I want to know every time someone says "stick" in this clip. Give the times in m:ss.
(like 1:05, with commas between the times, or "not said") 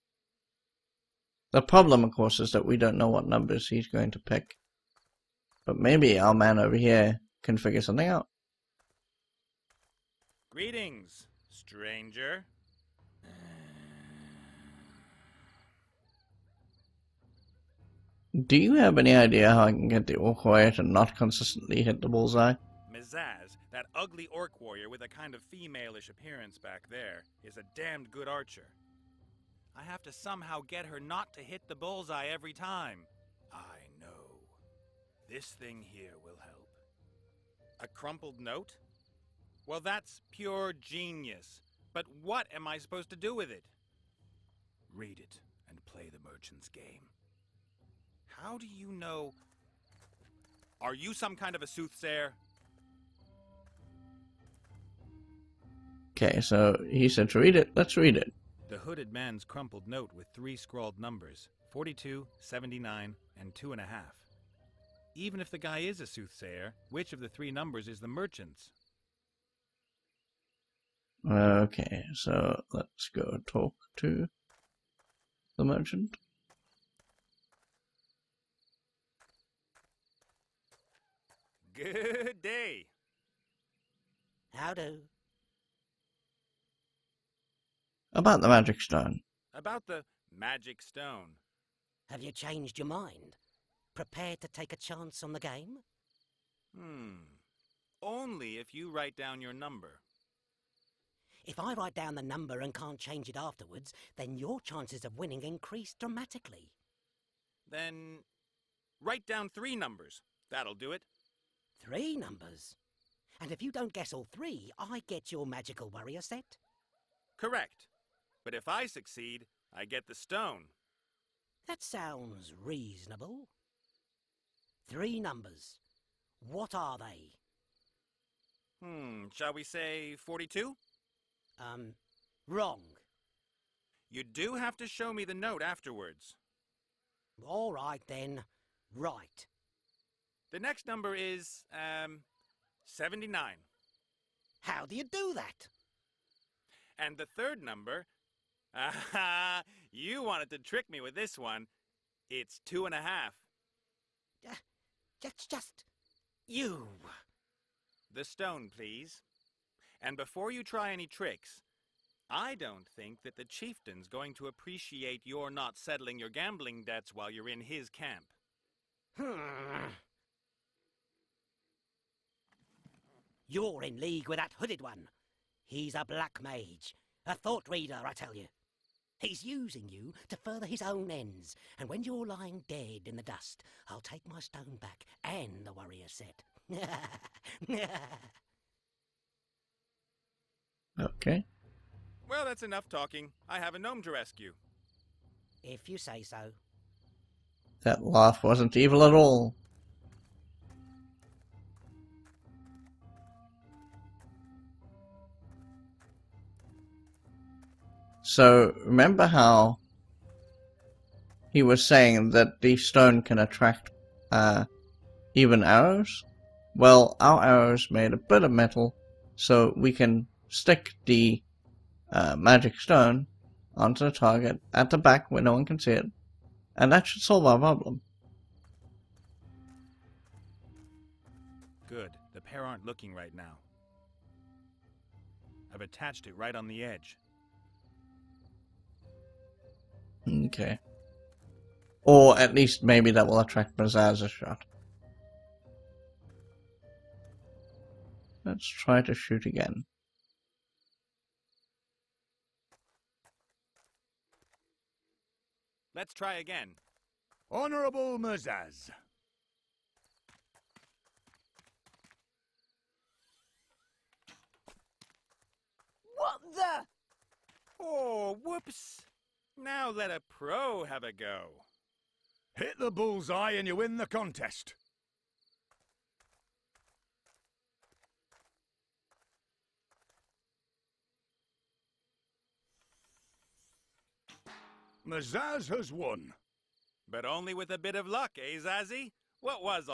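3:40.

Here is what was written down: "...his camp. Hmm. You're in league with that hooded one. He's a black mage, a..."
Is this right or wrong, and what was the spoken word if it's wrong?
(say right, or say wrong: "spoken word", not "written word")
right.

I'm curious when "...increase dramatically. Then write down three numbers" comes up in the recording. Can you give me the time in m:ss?
1:45.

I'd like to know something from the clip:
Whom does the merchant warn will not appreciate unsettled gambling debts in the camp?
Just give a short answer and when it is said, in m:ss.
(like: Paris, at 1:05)
The chieftain, at 2:43.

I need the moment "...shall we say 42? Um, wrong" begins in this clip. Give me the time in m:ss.
2:09.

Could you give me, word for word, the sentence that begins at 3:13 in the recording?
I have a gnome to rescue.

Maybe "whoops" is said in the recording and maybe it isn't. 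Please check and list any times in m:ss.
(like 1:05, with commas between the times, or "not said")
4:28.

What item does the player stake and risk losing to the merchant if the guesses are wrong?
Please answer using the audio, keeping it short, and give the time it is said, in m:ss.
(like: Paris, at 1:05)
Magical warrior set, at 1:55.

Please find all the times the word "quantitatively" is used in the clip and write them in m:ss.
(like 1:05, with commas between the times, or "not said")
not said.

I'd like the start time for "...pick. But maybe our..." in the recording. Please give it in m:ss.
0:04.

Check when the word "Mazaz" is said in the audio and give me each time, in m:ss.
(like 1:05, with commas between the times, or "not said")
0:22, 4:18, 4:45.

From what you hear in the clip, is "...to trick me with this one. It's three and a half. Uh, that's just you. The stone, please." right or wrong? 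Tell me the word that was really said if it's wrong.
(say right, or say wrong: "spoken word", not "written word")
wrong: "two", not "three".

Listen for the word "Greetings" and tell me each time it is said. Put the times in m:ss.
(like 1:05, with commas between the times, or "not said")
0:10.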